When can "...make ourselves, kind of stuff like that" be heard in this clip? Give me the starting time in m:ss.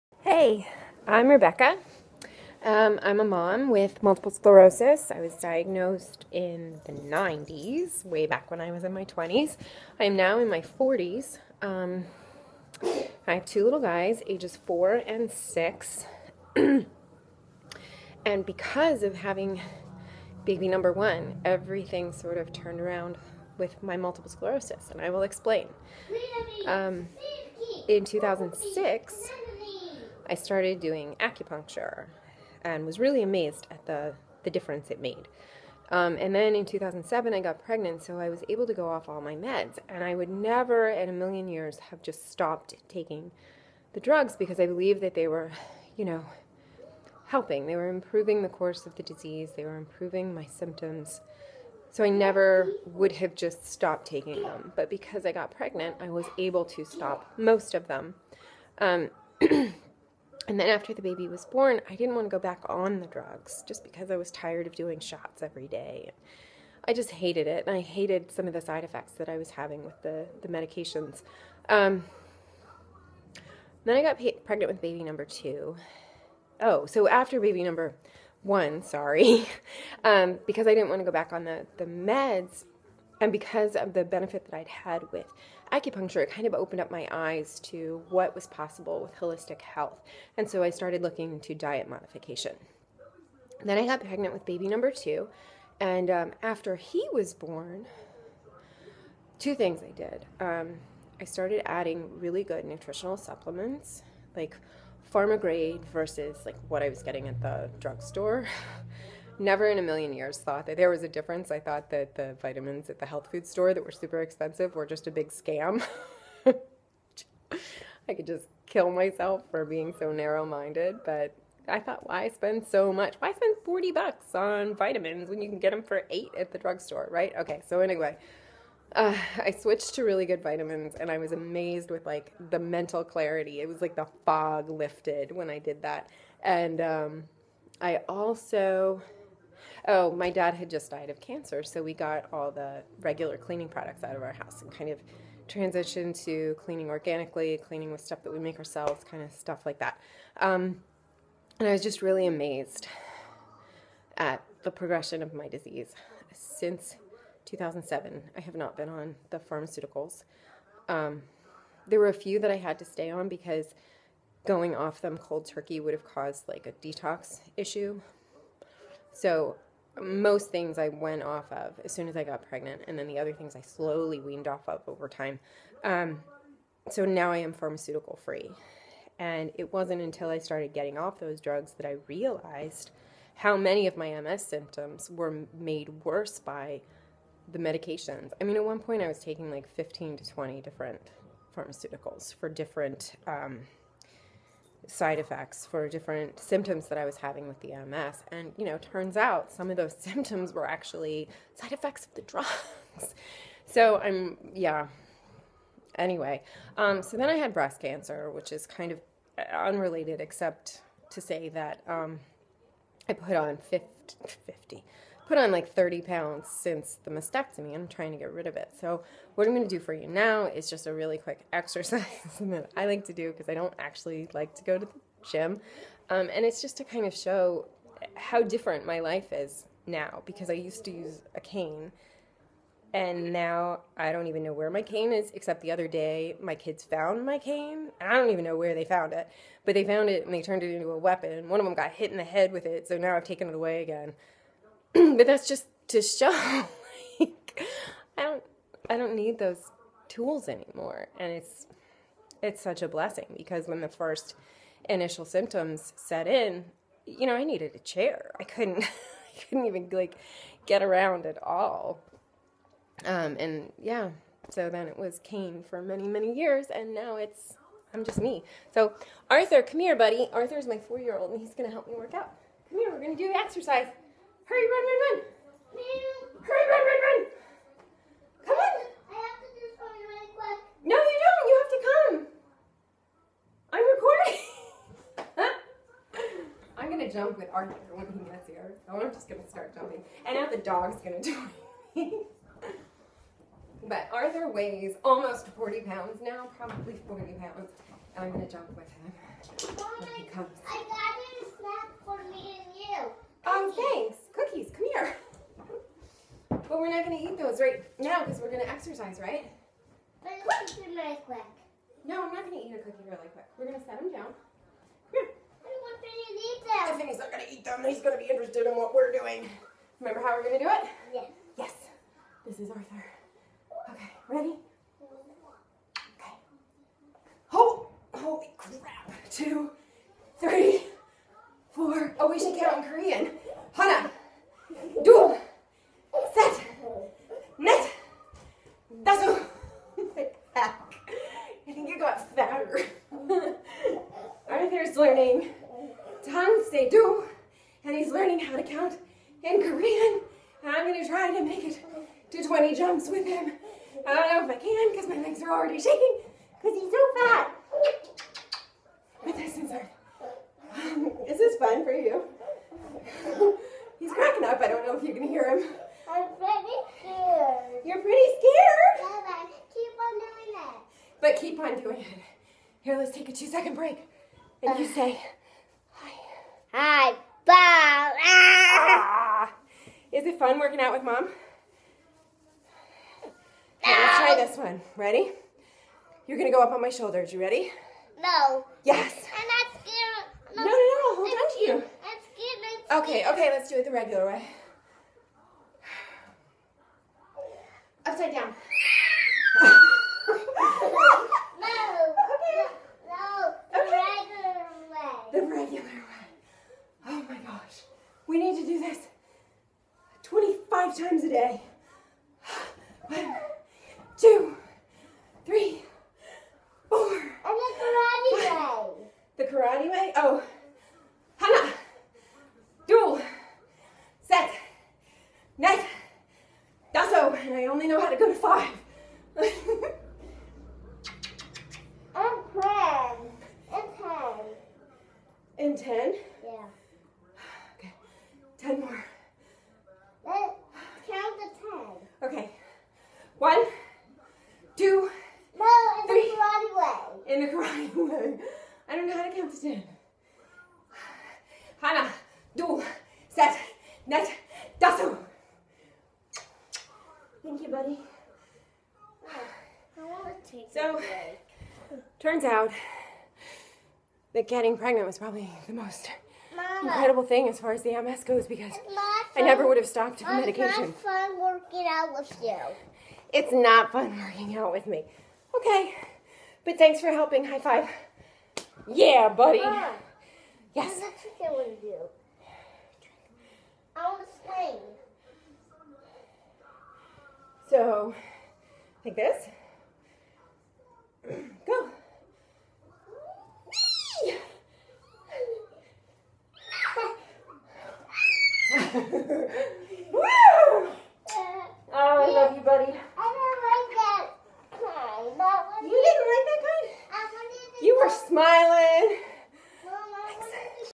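2:28.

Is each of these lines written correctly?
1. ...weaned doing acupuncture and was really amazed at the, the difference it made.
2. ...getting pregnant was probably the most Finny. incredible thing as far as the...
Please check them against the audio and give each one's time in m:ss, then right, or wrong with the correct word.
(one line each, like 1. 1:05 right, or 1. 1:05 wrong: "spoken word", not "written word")
1. 0:30 wrong: "started", not "weaned"
2. 7:44 wrong: "Mama", not "Finny".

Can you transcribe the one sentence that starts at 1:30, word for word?
And so I started looking into diet modification.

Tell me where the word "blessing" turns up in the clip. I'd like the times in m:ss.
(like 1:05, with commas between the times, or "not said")
4:12.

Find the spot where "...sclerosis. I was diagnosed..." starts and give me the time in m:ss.
0:04.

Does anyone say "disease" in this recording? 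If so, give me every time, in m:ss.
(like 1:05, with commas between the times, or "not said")
0:49, 2:35.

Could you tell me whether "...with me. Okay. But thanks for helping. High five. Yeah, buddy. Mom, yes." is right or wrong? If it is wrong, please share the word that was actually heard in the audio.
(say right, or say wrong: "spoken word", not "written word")
right.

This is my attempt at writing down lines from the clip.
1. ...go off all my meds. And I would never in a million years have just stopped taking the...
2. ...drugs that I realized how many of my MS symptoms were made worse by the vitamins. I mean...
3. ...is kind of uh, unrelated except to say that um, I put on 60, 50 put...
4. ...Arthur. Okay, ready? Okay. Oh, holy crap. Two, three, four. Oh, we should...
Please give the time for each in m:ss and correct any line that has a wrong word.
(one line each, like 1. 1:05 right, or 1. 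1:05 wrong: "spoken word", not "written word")
1. 0:38 right
2. 3:01 wrong: "medications", not "vitamins"
3. 3:28 wrong: "50", not "60"
4. 5:22 right.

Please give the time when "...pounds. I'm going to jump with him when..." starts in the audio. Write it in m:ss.
4:57.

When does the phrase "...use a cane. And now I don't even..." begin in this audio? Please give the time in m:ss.
3:50.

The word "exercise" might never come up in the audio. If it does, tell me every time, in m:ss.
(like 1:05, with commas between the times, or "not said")
3:41, 4:33, 5:08.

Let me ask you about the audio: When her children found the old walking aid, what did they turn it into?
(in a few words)
a weapon.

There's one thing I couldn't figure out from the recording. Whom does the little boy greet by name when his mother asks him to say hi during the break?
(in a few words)
Bob.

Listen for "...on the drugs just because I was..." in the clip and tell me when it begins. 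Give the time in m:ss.
1:02.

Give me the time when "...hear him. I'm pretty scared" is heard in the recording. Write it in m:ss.
6:05.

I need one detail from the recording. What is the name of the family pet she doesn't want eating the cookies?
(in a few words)
Finny.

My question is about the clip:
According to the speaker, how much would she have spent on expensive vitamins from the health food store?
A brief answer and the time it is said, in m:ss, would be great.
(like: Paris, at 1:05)
$40, at 2:03.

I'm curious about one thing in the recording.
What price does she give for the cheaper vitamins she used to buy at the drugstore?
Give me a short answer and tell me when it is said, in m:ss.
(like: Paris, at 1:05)
$8, at 2:06.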